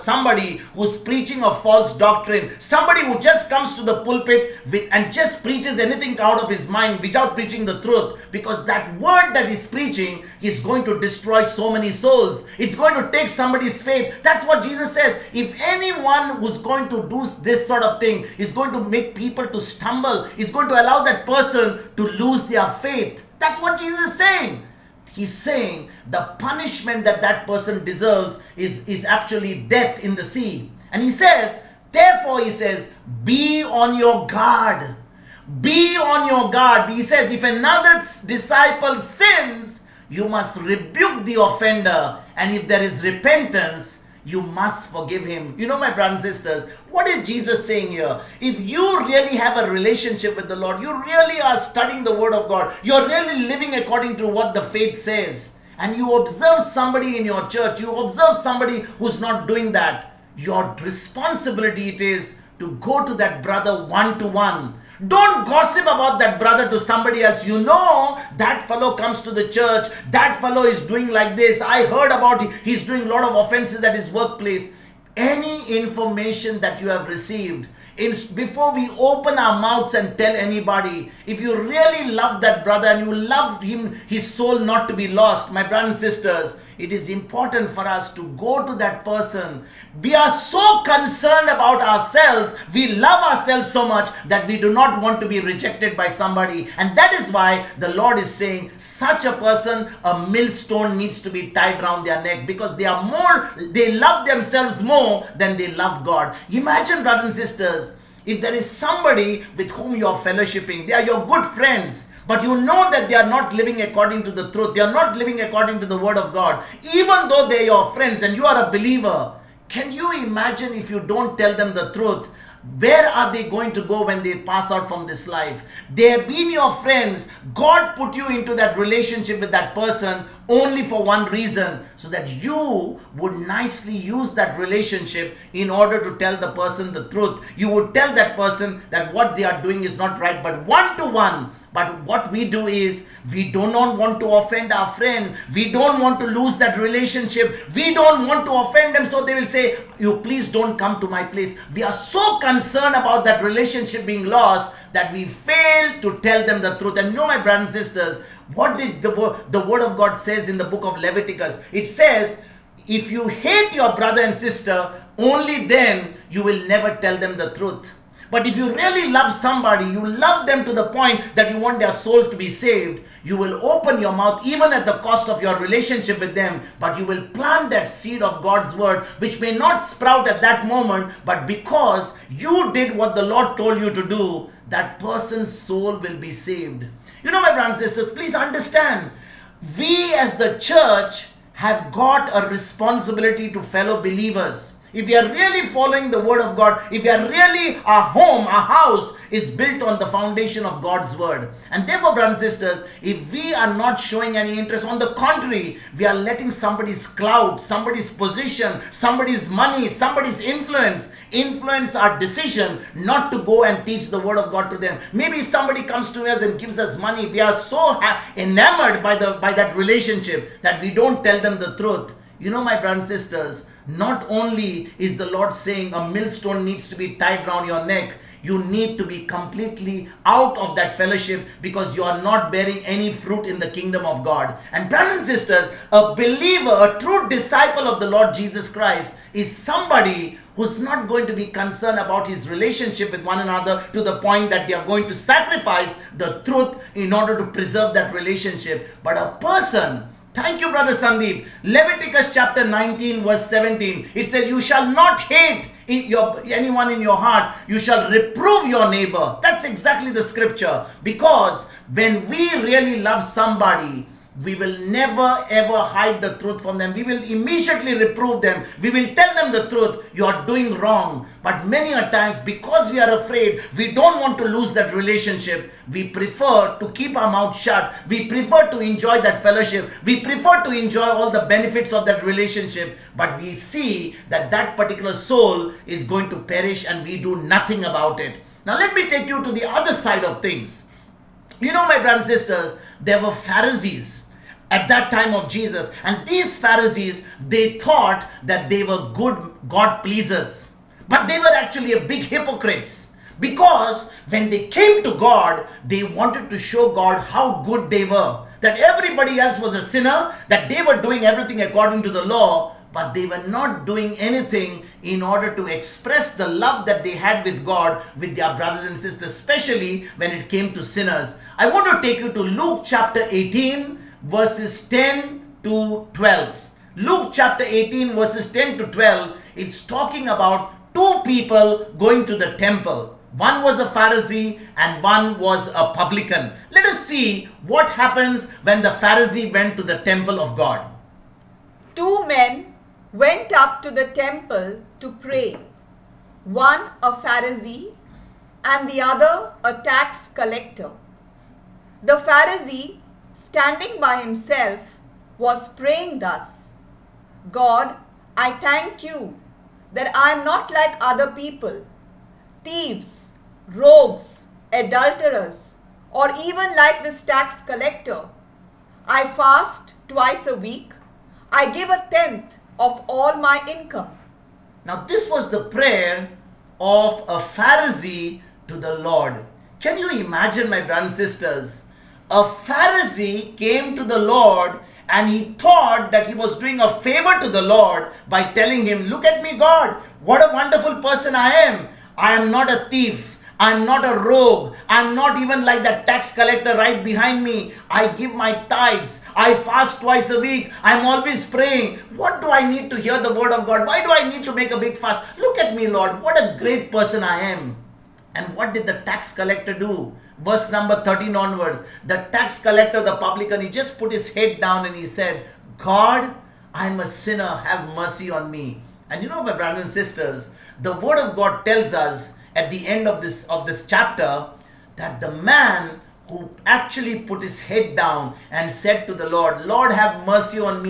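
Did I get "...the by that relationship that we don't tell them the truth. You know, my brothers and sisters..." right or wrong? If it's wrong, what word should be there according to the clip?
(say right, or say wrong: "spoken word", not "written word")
right.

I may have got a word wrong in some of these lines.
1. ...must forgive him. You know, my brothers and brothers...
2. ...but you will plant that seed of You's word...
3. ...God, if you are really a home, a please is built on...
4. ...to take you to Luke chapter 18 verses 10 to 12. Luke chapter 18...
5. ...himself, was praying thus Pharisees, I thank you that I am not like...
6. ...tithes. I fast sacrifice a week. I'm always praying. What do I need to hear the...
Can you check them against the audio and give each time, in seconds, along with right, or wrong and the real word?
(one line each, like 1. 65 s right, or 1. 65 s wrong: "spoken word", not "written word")
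1. 44 s wrong: "sisters", not "brothers"
2. 176 s wrong: "God", not "You"
3. 196 s wrong: "house", not "please"
4. 322 s right
5. 354 s wrong: "God", not "Pharisees"
6. 398 s wrong: "twice", not "sacrifice".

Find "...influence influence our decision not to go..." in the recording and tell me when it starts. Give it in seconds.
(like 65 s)
210 s.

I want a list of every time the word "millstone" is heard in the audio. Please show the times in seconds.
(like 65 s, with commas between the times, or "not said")
100 s, 226 s.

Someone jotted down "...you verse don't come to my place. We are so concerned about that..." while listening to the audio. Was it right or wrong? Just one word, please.
wrong.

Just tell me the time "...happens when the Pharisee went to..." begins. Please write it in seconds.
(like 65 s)
337 s.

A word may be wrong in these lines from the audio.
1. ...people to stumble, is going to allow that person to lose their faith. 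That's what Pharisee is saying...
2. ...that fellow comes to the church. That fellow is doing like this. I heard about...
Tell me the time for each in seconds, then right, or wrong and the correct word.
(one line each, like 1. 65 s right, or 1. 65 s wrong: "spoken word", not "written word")
1. 19 s wrong: "Jesus", not "Pharisee"
2. 68 s right.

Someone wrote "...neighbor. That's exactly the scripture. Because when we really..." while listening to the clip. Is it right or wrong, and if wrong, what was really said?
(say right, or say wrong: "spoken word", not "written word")
right.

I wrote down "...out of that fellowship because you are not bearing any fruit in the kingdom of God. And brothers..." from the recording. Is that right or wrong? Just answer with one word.
right.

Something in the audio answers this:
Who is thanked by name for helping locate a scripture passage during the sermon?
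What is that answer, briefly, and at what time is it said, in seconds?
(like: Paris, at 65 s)
Brother Sandeep, at 250 s.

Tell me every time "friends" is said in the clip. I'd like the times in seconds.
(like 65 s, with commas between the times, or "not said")
111 s, 117 s, 126 s, 144 s.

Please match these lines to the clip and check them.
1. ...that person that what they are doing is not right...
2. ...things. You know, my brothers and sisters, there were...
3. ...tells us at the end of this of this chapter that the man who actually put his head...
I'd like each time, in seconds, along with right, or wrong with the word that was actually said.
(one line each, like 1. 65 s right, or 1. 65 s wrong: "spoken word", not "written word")
1. 138 s right
2. 290 s right
3. 421 s right.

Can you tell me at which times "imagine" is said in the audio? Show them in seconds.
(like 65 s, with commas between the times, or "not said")
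106 s, 120 s, 380 s.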